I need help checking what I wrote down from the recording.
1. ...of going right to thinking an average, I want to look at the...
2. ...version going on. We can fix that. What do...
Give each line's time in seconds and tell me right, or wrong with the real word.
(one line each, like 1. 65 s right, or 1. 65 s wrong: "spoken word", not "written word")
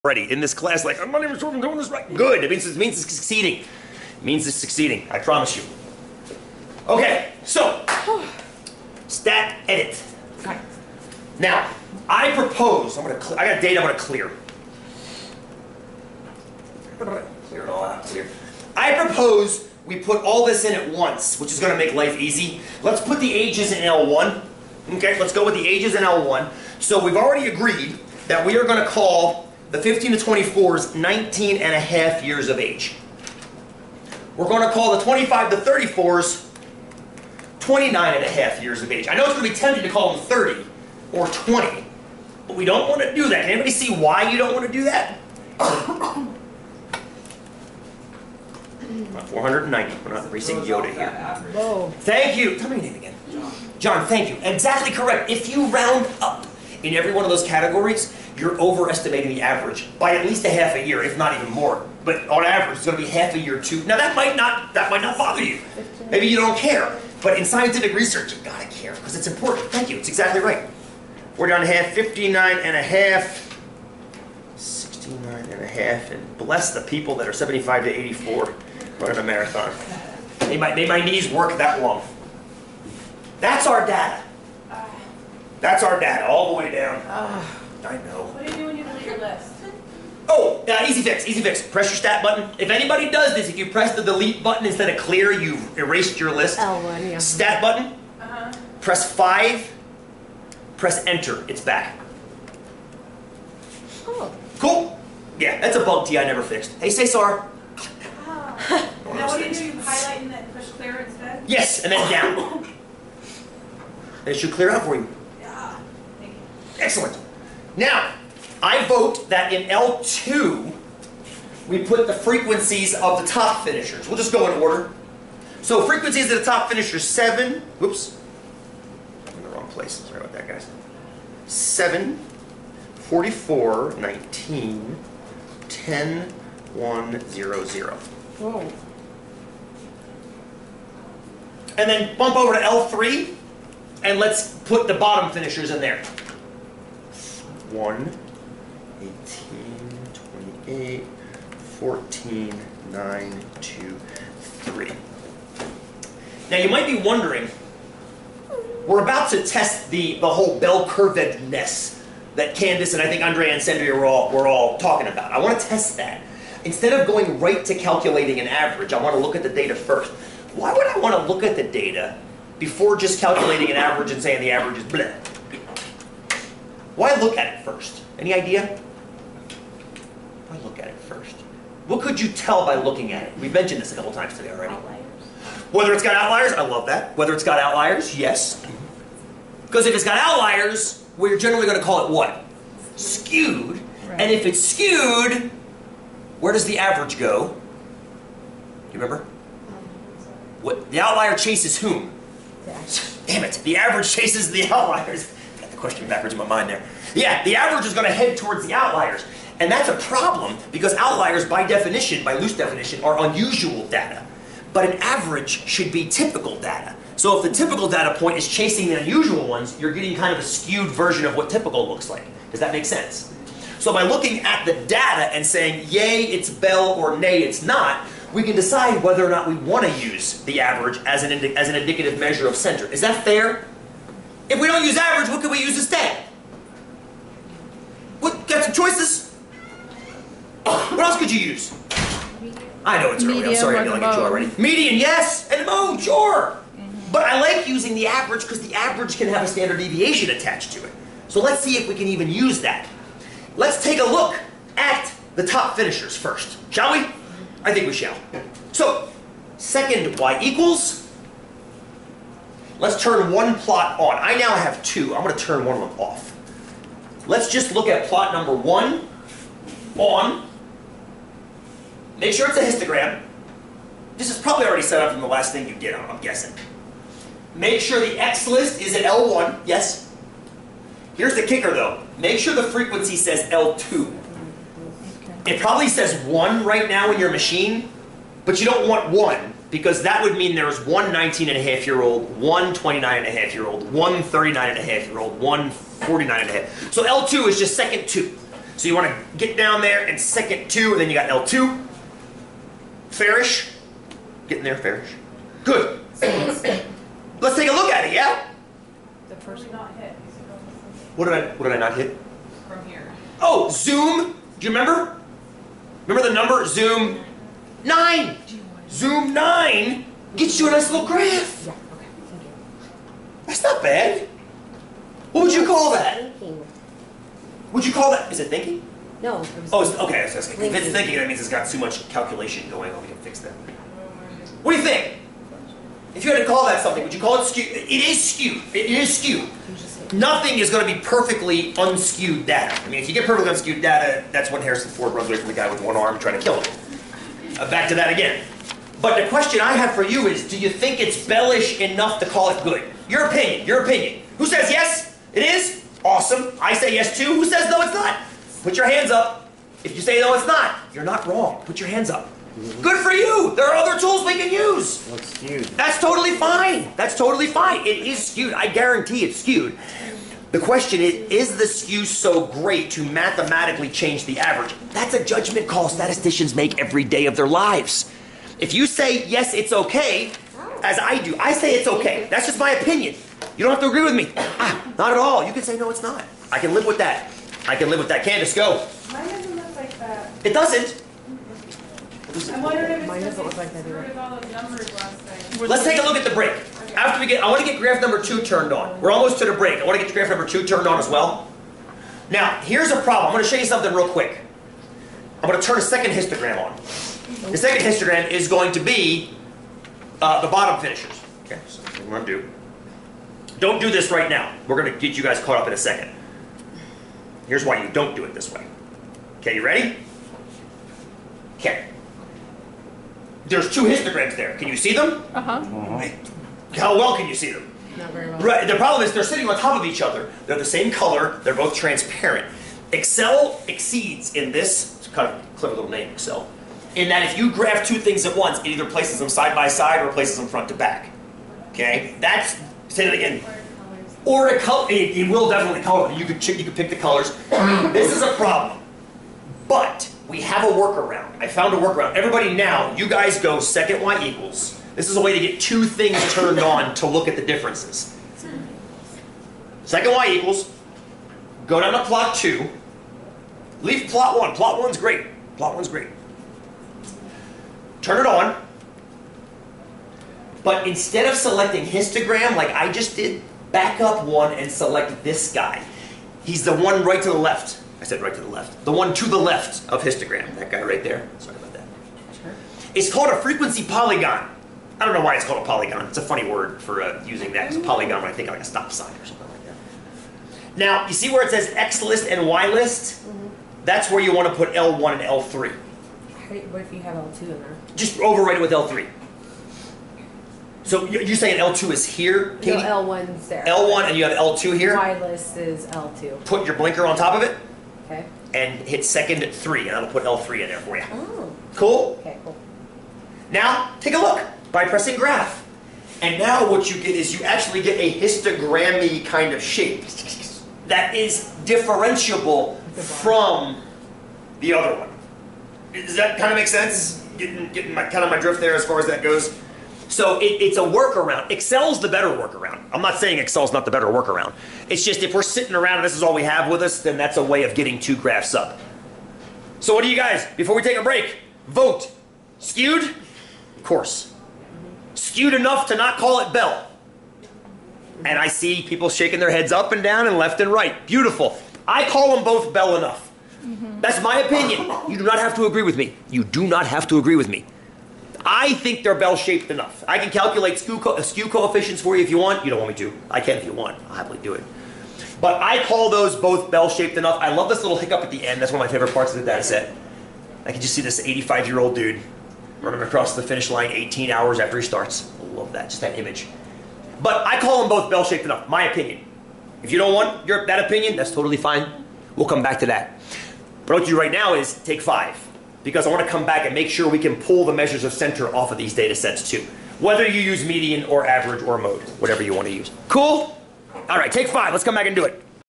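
1. 166 s wrong: "calculating", not "thinking"
2. 332 s wrong: "calculation", not "version".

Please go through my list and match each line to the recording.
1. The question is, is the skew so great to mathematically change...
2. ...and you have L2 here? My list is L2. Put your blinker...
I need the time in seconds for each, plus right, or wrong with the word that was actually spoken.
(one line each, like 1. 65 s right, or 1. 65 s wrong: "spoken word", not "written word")
1. 370 s right
2. 504 s right.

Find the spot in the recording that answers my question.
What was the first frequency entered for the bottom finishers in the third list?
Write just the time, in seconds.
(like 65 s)
147 s.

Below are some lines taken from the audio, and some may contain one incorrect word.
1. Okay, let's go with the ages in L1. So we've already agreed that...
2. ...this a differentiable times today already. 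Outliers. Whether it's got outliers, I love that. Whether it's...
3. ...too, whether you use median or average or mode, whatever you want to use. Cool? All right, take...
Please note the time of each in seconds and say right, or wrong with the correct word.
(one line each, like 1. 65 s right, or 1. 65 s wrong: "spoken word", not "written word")
1. 24 s right
2. 183 s wrong: "couple", not "differentiable"
3. 589 s right.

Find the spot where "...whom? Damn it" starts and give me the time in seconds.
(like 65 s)
201 s.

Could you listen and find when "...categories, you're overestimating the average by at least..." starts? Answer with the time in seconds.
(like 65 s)
57 s.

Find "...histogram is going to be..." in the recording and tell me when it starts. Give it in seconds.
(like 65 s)
407 s.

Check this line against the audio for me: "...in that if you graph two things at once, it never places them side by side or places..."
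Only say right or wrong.
wrong.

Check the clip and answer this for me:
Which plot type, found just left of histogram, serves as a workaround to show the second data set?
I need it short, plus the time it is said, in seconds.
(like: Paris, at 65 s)
frequency polygon, at 483 s.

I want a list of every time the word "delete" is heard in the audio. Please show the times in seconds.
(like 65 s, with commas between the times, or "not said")
88 s, 94 s.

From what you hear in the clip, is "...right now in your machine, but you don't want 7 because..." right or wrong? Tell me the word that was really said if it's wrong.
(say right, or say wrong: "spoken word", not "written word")
wrong: "1", not "7".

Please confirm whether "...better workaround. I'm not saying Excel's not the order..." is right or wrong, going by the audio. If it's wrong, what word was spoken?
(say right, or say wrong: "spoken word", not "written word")
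wrong: "better", not "order".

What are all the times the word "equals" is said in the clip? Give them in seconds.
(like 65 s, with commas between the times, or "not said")
260 s, 454 s, 460 s.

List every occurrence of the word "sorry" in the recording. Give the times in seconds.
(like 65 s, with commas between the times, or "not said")
129 s, 243 s, 481 s.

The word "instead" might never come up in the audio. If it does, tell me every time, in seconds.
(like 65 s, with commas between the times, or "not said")
94 s, 111 s, 166 s, 235 s, 470 s.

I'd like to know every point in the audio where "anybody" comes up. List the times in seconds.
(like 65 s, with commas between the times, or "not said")
43 s, 92 s.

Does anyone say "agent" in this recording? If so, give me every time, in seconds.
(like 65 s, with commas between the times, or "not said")
not said.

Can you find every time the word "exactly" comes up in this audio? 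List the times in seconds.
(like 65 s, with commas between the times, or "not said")
54 s, 70 s.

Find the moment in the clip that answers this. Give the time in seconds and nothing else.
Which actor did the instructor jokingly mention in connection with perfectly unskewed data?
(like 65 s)
344 s.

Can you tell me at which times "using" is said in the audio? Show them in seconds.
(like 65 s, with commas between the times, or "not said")
247 s, 487 s.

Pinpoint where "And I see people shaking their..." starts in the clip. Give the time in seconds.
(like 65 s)
548 s.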